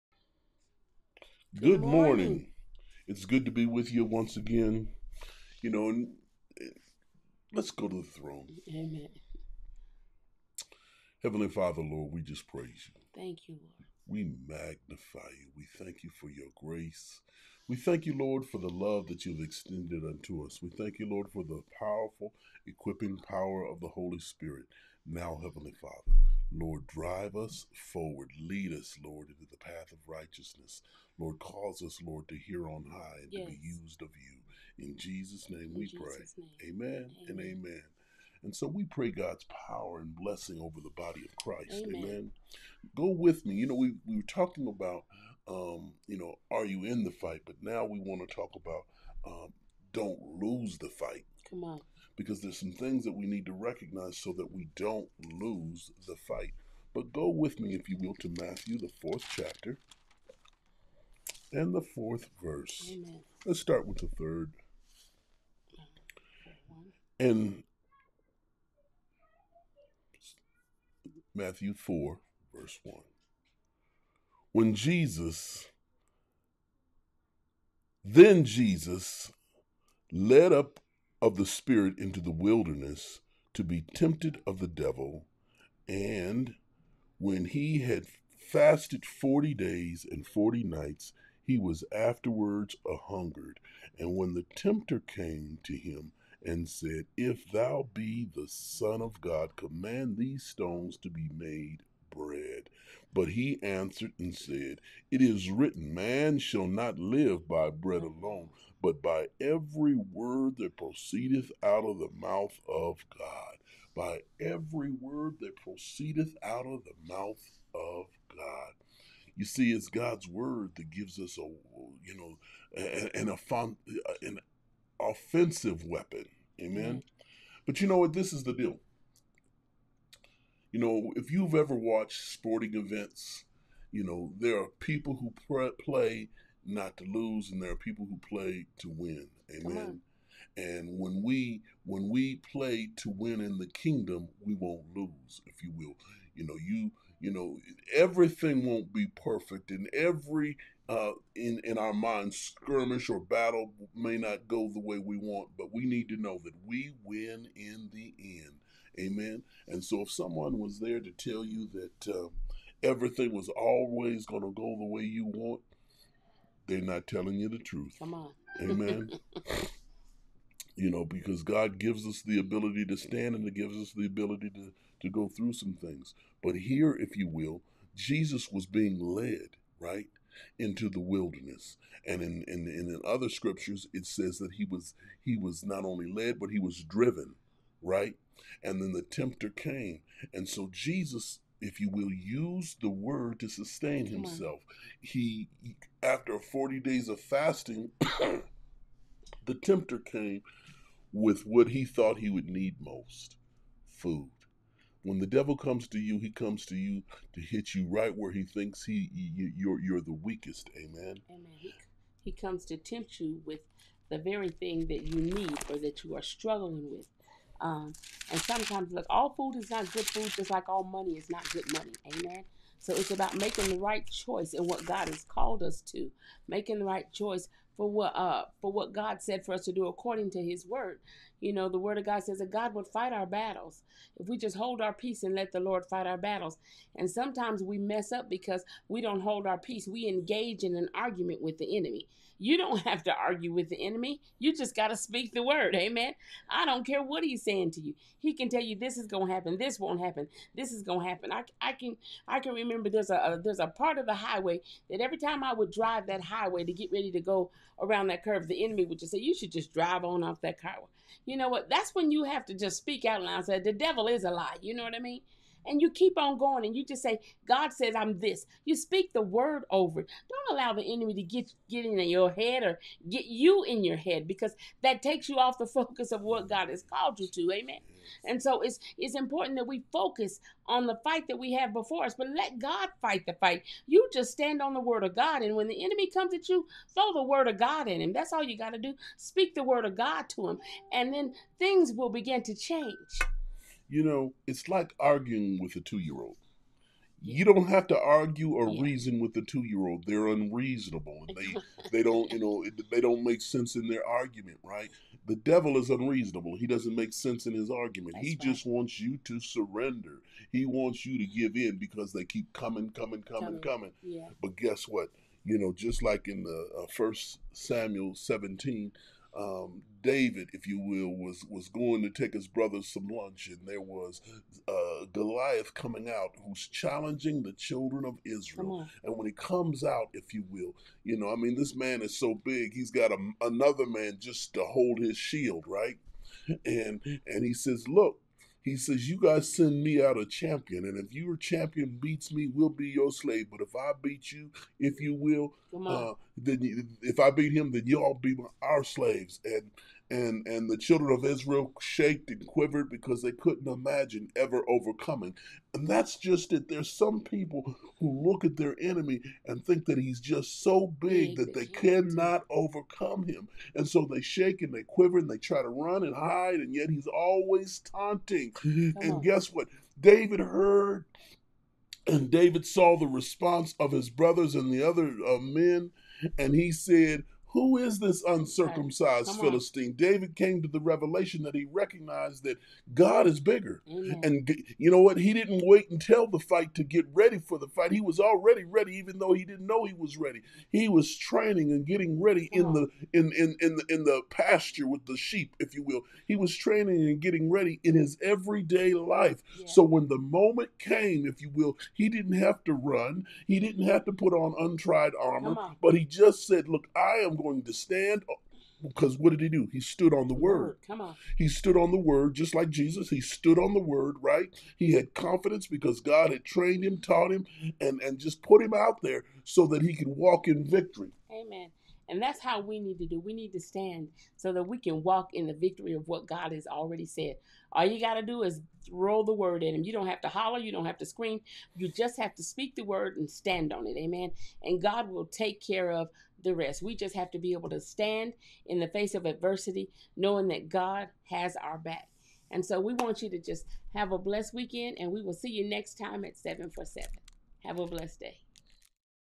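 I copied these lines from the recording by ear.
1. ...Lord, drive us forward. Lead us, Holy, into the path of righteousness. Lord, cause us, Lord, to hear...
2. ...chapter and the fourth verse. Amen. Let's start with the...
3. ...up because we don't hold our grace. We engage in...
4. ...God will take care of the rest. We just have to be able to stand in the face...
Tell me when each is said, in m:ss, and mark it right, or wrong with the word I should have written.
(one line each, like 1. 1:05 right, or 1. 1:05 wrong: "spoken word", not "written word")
1. 0:26 wrong: "Lord", not "Holy"
2. 0:59 right
3. 3:58 wrong: "peace", not "grace"
4. 7:14 right.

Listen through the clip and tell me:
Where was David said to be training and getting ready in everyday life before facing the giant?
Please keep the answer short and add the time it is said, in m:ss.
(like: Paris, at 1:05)
the pasture, at 6:34.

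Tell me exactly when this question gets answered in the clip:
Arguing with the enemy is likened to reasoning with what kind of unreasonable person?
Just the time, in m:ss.
4:55.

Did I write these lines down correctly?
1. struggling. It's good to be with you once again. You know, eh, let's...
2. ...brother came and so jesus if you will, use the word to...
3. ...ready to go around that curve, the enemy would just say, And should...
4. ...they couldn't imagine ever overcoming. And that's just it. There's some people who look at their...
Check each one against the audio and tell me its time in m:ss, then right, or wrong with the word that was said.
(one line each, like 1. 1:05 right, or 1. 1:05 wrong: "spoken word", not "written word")
1. 0:02 wrong: "morning", not "struggling"
2. 3:09 wrong: "tempter", not "brother"
3. 4:16 wrong: "You", not "And"
4. 5:53 right.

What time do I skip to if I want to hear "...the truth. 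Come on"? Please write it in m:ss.
2:47.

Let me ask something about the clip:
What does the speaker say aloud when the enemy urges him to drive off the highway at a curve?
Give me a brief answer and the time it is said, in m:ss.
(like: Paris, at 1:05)
The devil is a lie, at 4:23.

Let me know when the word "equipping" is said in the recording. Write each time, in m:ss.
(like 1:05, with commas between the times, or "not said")
0:22.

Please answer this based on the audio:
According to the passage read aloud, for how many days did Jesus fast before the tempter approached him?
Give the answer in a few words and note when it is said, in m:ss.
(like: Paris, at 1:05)
40, at 1:29.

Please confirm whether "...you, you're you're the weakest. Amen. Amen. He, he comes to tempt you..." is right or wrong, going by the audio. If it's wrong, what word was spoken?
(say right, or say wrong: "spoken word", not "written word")
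right.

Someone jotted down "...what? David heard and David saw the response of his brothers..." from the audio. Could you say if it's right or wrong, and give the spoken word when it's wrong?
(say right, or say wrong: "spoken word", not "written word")
right.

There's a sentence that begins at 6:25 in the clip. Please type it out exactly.
He didn't wait until the fight to get ready for the fight.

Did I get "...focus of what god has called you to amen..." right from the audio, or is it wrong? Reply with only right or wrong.
right.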